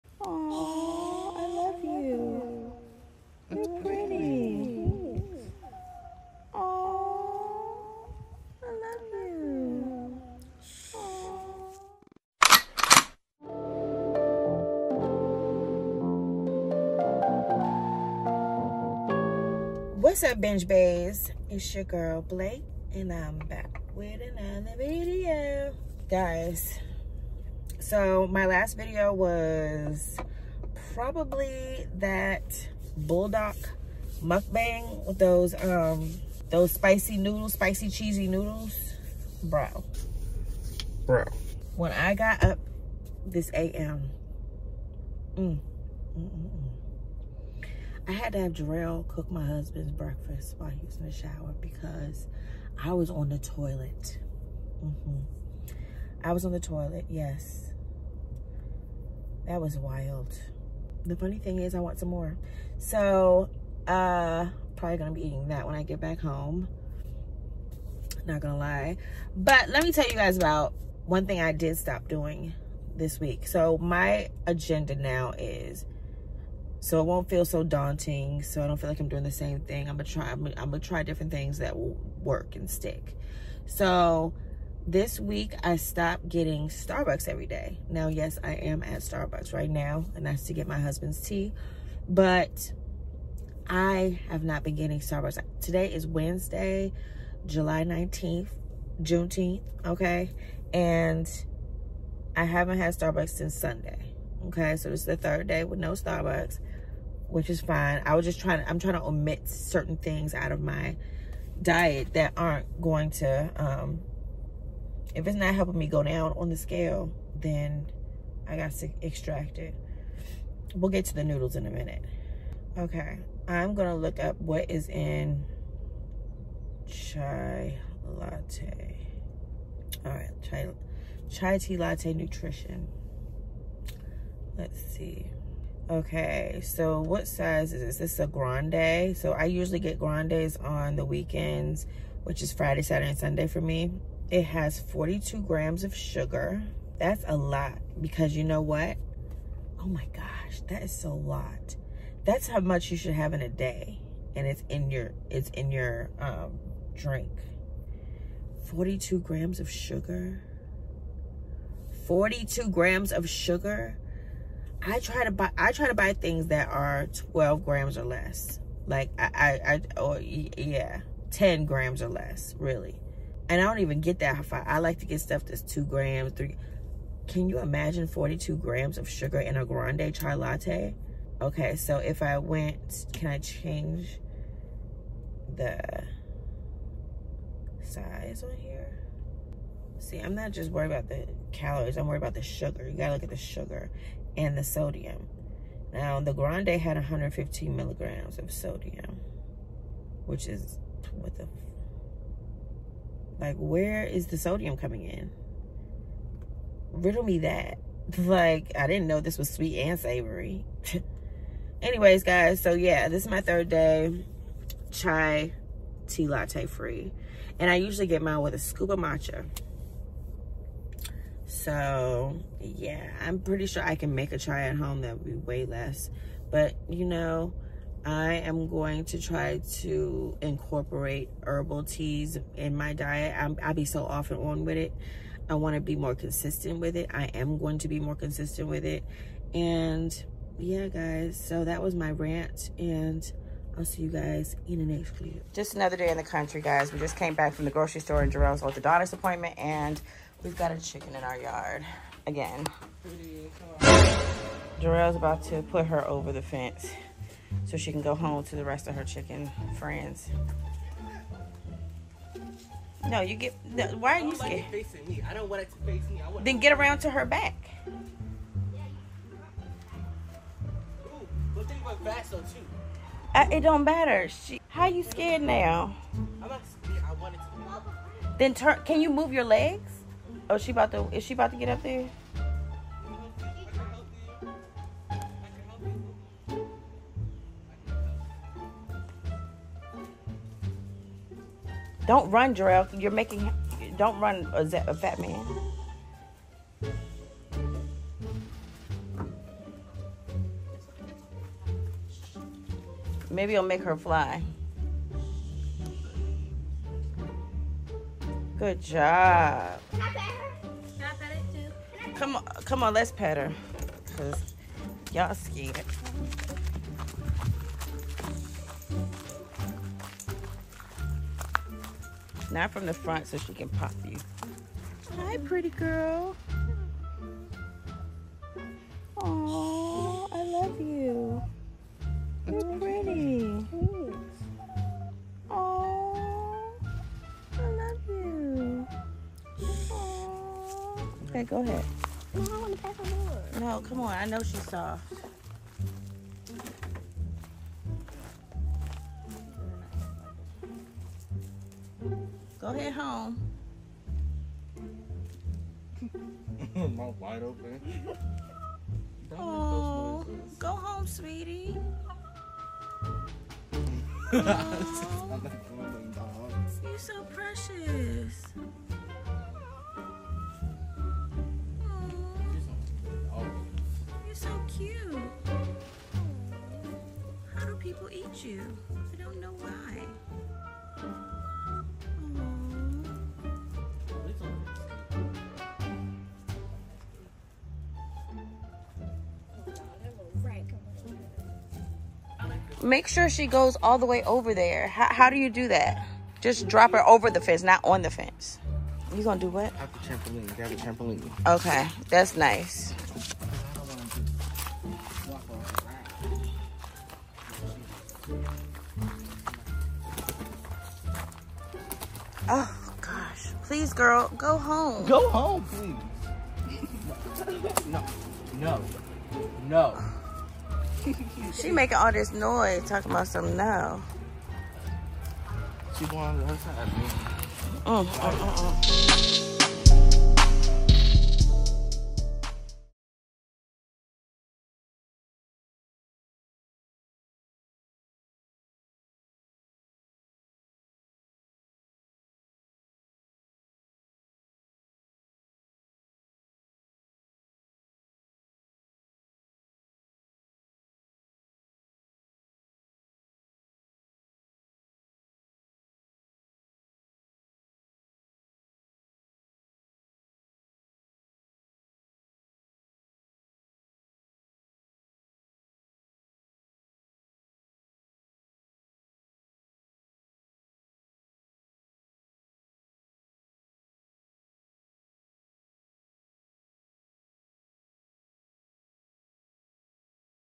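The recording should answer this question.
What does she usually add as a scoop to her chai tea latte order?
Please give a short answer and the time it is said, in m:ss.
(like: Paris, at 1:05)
matcha, at 3:38.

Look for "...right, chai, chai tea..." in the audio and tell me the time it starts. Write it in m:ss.
2:10.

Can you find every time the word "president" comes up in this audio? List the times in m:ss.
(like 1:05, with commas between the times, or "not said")
not said.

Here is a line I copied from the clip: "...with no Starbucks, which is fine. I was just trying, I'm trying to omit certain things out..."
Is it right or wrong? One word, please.
right.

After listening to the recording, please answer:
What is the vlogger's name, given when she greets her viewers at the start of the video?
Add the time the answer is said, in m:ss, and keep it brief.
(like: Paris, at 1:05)
Blake, at 0:22.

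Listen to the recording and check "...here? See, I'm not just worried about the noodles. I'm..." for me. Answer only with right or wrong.
wrong.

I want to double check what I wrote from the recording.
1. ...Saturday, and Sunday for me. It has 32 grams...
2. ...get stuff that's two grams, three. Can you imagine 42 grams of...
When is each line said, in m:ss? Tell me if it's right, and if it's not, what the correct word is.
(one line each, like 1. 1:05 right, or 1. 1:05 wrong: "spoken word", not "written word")
1. 2:22 wrong: "42", not "32"
2. 2:55 right.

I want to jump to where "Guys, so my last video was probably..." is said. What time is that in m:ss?
0:26.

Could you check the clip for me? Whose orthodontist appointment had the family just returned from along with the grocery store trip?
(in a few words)
Jerome.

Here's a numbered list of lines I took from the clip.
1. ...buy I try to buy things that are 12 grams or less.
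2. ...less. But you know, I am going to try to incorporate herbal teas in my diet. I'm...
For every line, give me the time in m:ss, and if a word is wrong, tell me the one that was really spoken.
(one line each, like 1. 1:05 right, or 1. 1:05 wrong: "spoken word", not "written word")
1. 2:45 right
2. 3:45 right.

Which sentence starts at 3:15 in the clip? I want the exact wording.
Now, the Grande had 115 milligrams of sodium, which is what the, like, where is the sodium coming in?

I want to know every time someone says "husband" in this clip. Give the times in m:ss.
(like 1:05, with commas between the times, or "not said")
0:49, 1:30.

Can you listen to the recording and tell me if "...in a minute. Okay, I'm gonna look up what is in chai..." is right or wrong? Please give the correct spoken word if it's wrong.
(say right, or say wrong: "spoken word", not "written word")
right.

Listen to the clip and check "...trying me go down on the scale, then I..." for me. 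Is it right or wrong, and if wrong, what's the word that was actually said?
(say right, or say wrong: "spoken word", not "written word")
wrong: "helping", not "trying".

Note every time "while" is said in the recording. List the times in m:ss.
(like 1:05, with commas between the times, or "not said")
0:50.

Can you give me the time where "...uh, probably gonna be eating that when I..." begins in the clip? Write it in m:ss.
1:03.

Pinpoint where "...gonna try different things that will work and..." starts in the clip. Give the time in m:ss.
1:20.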